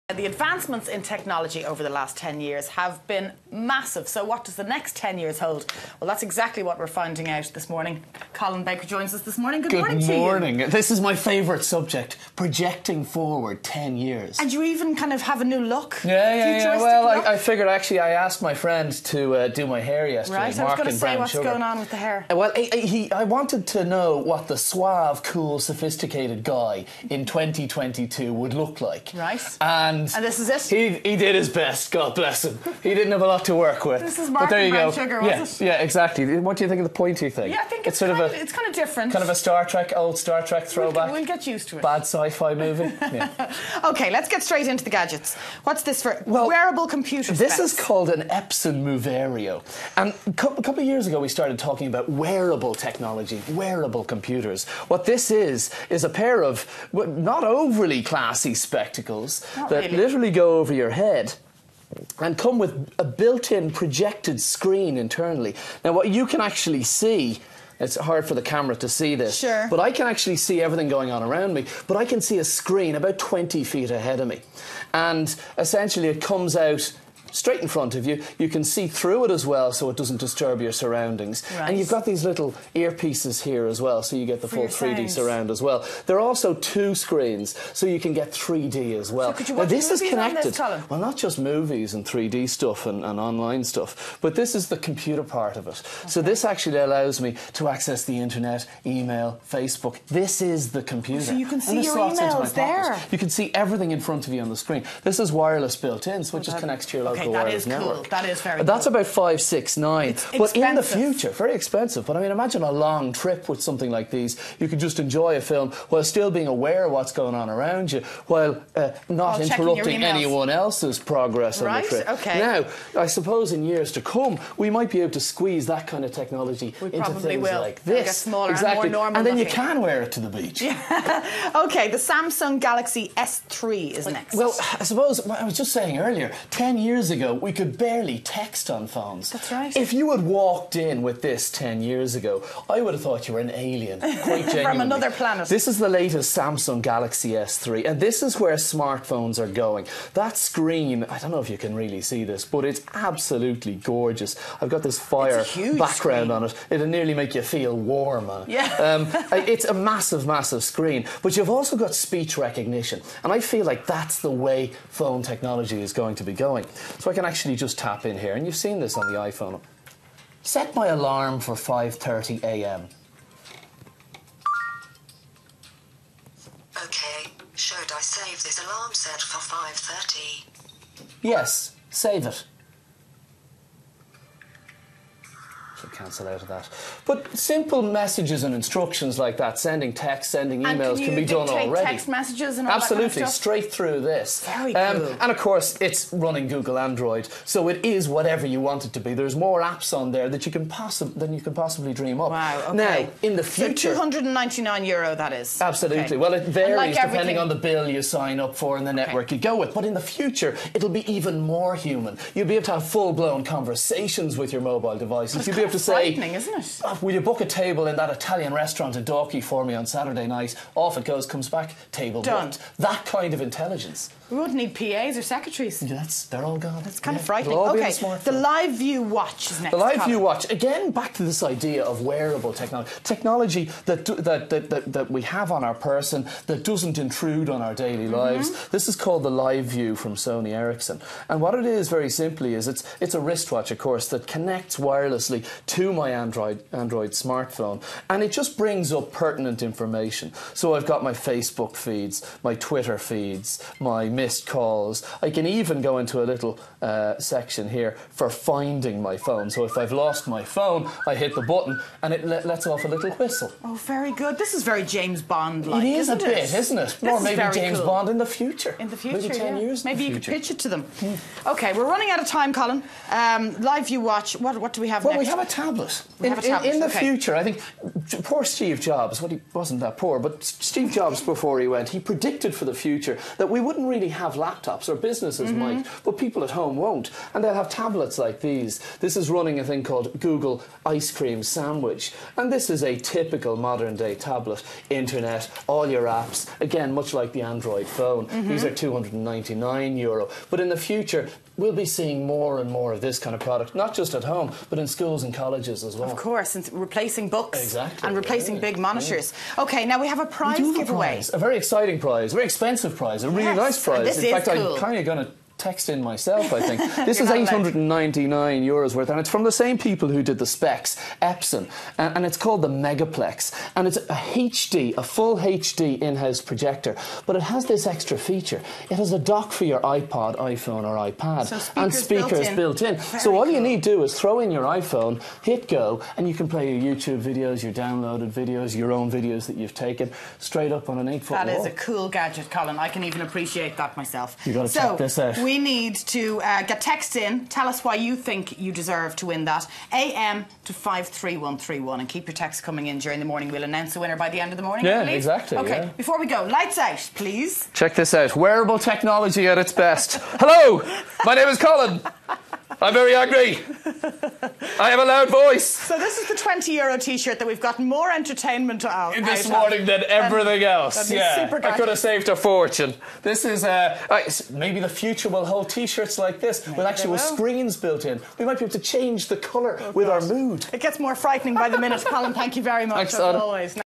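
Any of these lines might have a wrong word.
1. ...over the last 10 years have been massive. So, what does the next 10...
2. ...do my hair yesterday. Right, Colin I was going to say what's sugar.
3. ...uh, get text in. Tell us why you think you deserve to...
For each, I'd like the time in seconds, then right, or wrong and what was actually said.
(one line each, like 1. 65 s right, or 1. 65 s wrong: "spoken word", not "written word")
1. 1 s right
2. 19 s wrong: "Mark", not "Colin"
3. 346 s right.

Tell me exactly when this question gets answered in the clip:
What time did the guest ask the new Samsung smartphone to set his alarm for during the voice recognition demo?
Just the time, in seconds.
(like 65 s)
171 s.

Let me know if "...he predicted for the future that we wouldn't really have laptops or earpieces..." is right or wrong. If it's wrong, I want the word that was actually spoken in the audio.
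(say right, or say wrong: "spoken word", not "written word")
wrong: "businesses", not "earpieces".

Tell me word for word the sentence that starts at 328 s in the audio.
It has a dock for your iPod, iPhone, or iPad, so speakers and speakers built in.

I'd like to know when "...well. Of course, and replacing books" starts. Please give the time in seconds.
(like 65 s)
305 s.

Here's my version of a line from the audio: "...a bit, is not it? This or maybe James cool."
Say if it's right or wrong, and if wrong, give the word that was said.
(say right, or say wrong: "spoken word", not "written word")
right.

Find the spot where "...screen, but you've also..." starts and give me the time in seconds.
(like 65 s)
160 s.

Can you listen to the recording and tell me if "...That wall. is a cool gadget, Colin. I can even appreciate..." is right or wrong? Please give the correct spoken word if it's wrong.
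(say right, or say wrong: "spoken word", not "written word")
right.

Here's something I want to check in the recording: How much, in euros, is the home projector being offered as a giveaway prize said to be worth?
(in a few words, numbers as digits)
899 euros.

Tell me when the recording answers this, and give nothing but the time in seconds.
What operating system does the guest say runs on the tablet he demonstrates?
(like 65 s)
290 s.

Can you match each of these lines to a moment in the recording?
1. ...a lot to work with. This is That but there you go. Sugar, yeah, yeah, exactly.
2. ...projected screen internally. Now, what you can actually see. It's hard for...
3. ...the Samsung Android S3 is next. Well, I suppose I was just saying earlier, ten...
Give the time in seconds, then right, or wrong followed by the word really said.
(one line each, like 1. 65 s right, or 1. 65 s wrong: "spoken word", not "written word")
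1. 33 s wrong: "Martin", not "That"
2. 63 s right
3. 131 s wrong: "Galaxy", not "Android".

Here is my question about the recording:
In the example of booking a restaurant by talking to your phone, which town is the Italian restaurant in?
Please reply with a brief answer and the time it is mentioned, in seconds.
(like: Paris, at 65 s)
Dalkey, at 219 s.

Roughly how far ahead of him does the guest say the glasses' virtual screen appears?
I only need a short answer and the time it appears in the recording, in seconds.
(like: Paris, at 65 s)
20 feet, at 73 s.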